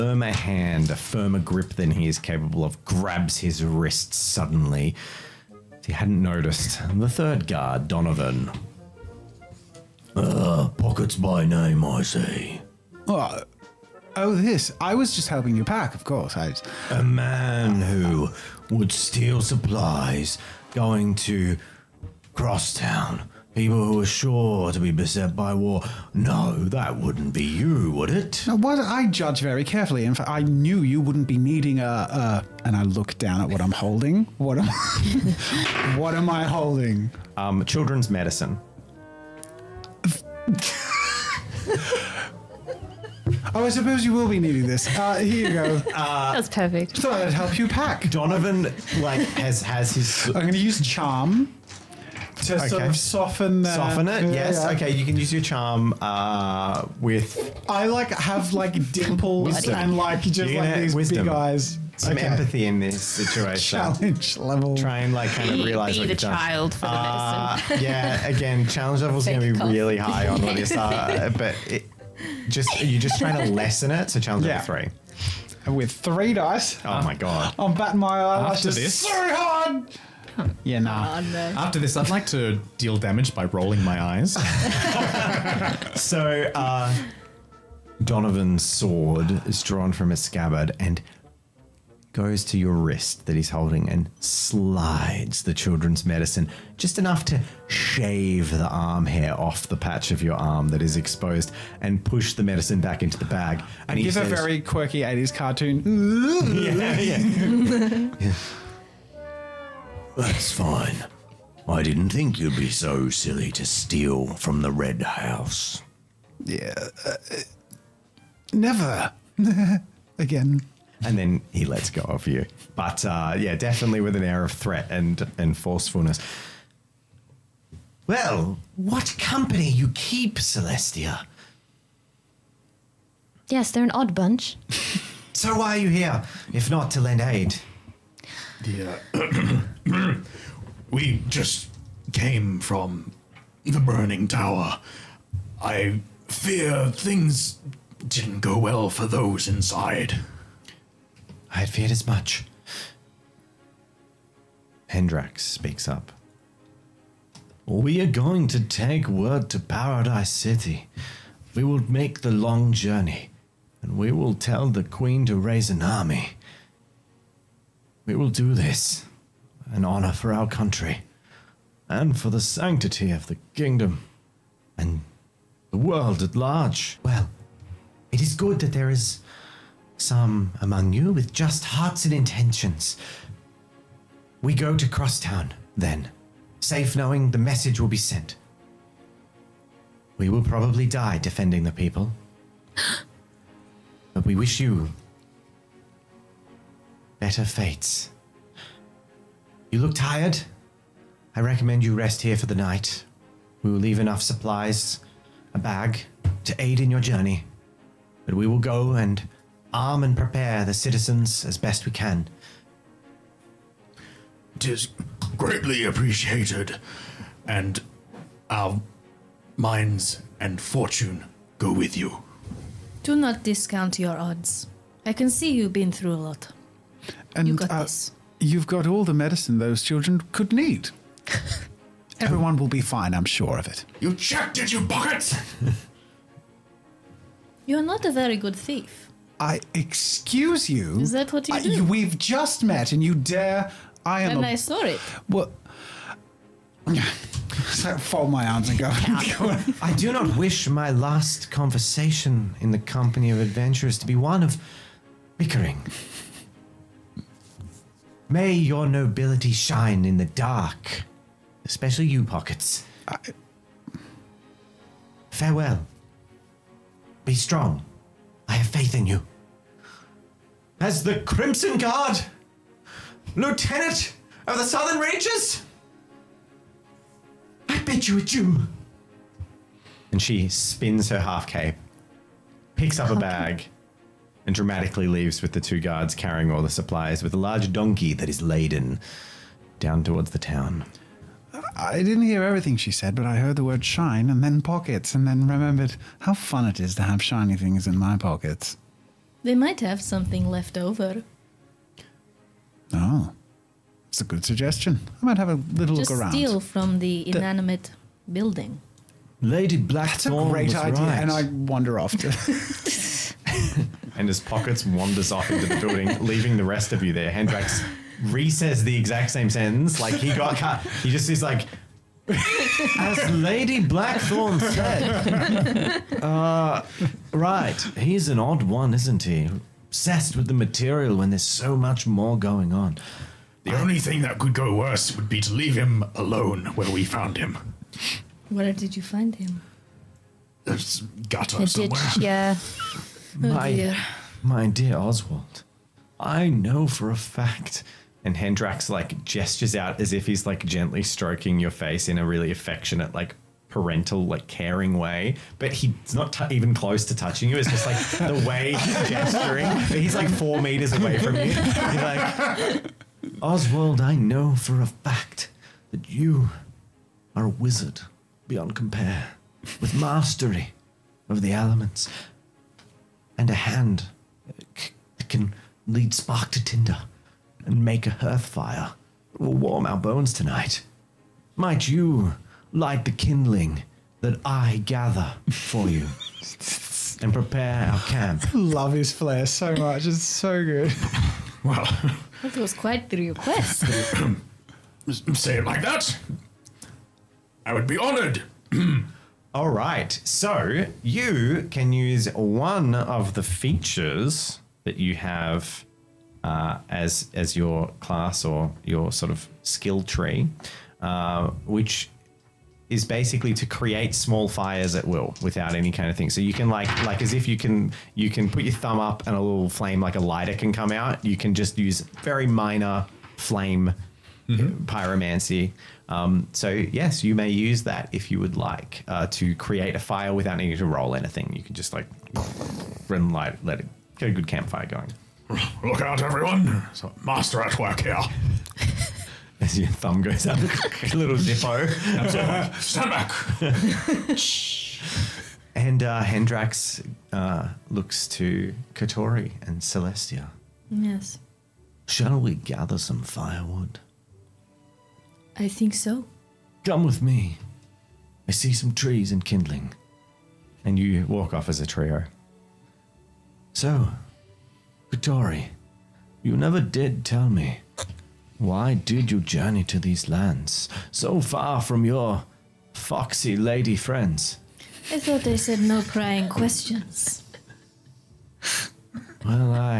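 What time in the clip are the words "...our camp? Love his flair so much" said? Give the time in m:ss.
6:27.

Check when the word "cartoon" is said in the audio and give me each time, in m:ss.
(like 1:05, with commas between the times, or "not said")
1:45.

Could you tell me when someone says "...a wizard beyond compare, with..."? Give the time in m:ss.
6:07.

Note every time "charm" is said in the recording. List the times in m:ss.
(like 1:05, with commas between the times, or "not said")
0:50, 0:55.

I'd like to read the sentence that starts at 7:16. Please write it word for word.
It's a master at work here.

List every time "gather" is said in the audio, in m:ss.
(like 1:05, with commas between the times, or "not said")
6:24, 7:32.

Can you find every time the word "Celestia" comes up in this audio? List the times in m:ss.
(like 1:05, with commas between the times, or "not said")
2:10, 7:29.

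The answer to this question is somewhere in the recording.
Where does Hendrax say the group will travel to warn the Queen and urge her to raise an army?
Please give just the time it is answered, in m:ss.
2:39.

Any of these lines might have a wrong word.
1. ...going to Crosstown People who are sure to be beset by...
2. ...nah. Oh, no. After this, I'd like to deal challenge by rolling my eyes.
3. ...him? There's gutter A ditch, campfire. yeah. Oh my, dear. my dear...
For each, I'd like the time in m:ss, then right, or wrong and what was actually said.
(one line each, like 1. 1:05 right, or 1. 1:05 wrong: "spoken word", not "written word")
1. 0:20 right
2. 1:20 wrong: "damage", not "challenge"
3. 5:39 wrong: "somewhere", not "campfire".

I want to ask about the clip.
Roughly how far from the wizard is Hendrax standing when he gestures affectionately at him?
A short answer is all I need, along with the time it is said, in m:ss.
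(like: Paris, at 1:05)
4 meters, at 6:00.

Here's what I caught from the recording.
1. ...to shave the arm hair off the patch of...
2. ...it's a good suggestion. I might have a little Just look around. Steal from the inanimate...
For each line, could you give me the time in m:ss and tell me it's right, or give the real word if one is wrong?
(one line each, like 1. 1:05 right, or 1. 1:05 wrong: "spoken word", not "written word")
1. 1:37 right
2. 5:04 right.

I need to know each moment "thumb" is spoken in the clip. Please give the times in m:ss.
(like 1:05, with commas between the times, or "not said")
6:58, 7:19.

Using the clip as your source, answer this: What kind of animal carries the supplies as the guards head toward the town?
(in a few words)
Donkey.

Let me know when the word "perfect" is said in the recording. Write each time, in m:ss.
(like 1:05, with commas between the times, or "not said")
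0:46.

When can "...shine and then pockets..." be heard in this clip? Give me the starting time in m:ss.
4:53.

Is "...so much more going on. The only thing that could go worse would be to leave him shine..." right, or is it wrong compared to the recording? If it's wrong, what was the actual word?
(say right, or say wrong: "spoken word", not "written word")
wrong: "alone", not "shine".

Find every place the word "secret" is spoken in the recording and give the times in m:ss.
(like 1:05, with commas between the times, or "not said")
not said.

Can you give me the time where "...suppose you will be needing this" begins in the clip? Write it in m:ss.
0:43.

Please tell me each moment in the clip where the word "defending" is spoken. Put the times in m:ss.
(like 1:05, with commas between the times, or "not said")
3:11.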